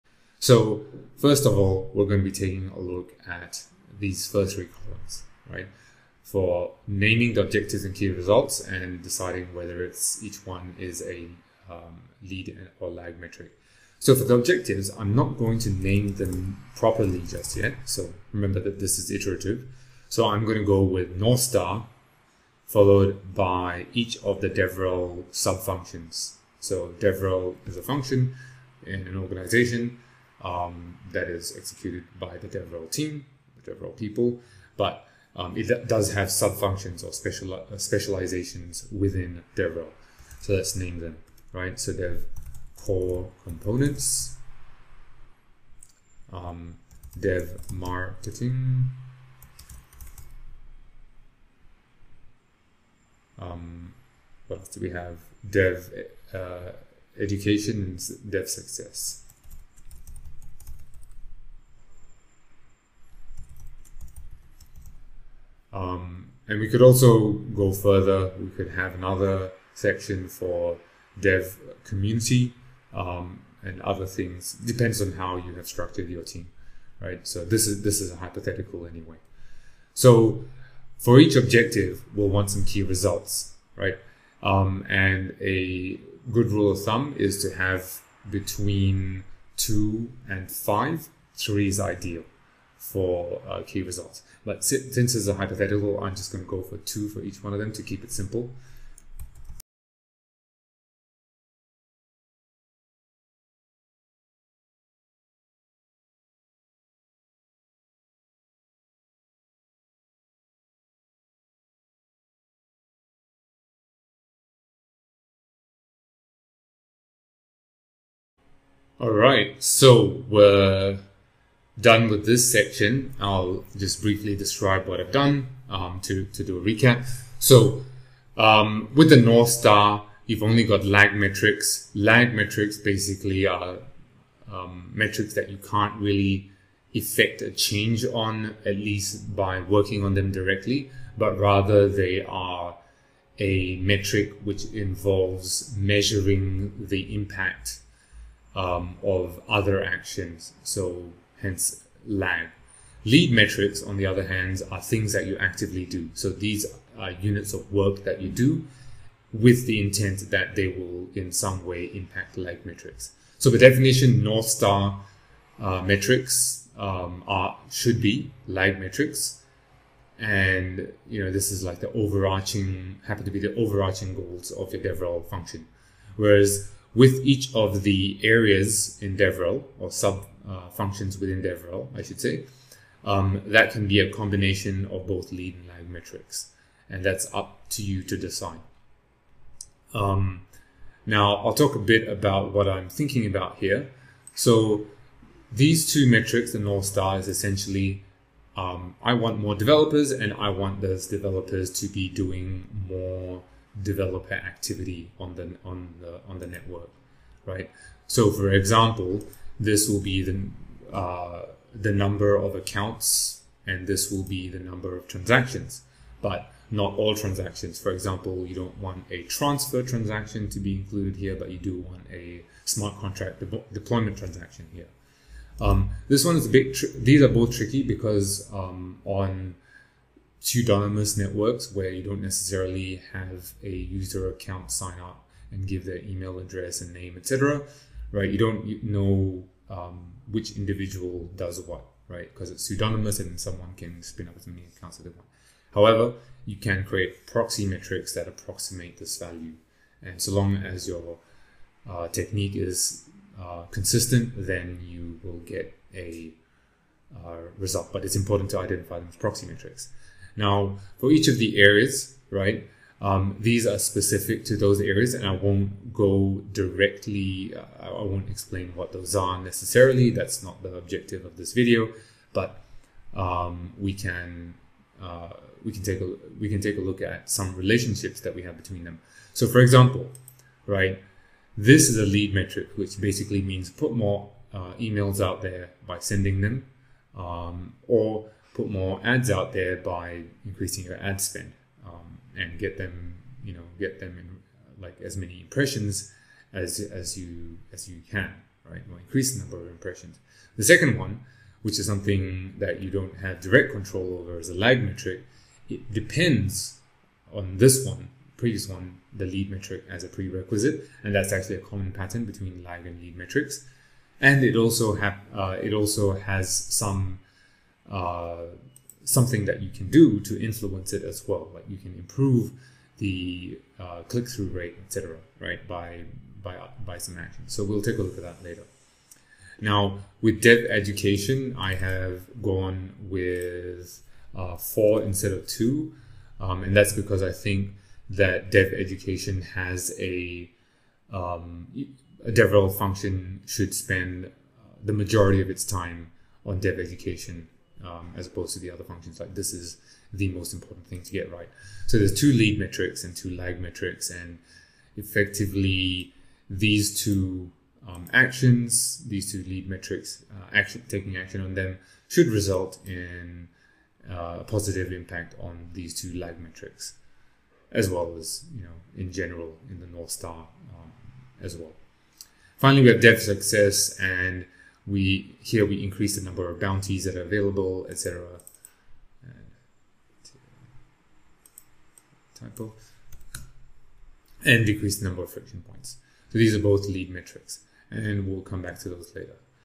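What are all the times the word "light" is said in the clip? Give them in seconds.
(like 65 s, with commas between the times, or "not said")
not said.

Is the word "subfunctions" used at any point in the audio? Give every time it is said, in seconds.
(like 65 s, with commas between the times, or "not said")
36 s.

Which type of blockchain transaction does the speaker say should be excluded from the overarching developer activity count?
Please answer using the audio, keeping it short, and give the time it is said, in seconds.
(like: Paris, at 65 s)
transfer transaction, at 219 s.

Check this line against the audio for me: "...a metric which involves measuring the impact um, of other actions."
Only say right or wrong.
right.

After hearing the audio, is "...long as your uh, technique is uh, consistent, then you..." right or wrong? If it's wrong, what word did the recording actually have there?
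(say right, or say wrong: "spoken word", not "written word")
right.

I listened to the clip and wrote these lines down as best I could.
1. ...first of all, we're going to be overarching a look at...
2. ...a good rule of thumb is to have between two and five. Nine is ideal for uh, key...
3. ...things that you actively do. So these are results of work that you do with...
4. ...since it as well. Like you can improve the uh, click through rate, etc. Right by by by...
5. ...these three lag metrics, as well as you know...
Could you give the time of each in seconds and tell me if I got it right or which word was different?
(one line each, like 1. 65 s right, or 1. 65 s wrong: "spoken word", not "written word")
1. 1 s wrong: "taking", not "overarching"
2. 85 s wrong: "Three", not "Nine"
3. 154 s wrong: "units", not "results"
4. 320 s wrong: "influence", not "since"
5. 365 s wrong: "two", not "three".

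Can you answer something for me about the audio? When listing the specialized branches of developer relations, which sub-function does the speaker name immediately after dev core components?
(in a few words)
Dev marketing.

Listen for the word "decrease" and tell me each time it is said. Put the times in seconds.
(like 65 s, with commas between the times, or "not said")
384 s.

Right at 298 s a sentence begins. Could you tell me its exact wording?
Or increase the number of impressions.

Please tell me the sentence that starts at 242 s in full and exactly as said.
Because it's pseudonymous and someone can spin up as many accounts as they want.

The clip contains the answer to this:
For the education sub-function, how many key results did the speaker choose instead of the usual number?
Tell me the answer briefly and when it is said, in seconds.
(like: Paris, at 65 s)
4, at 334 s.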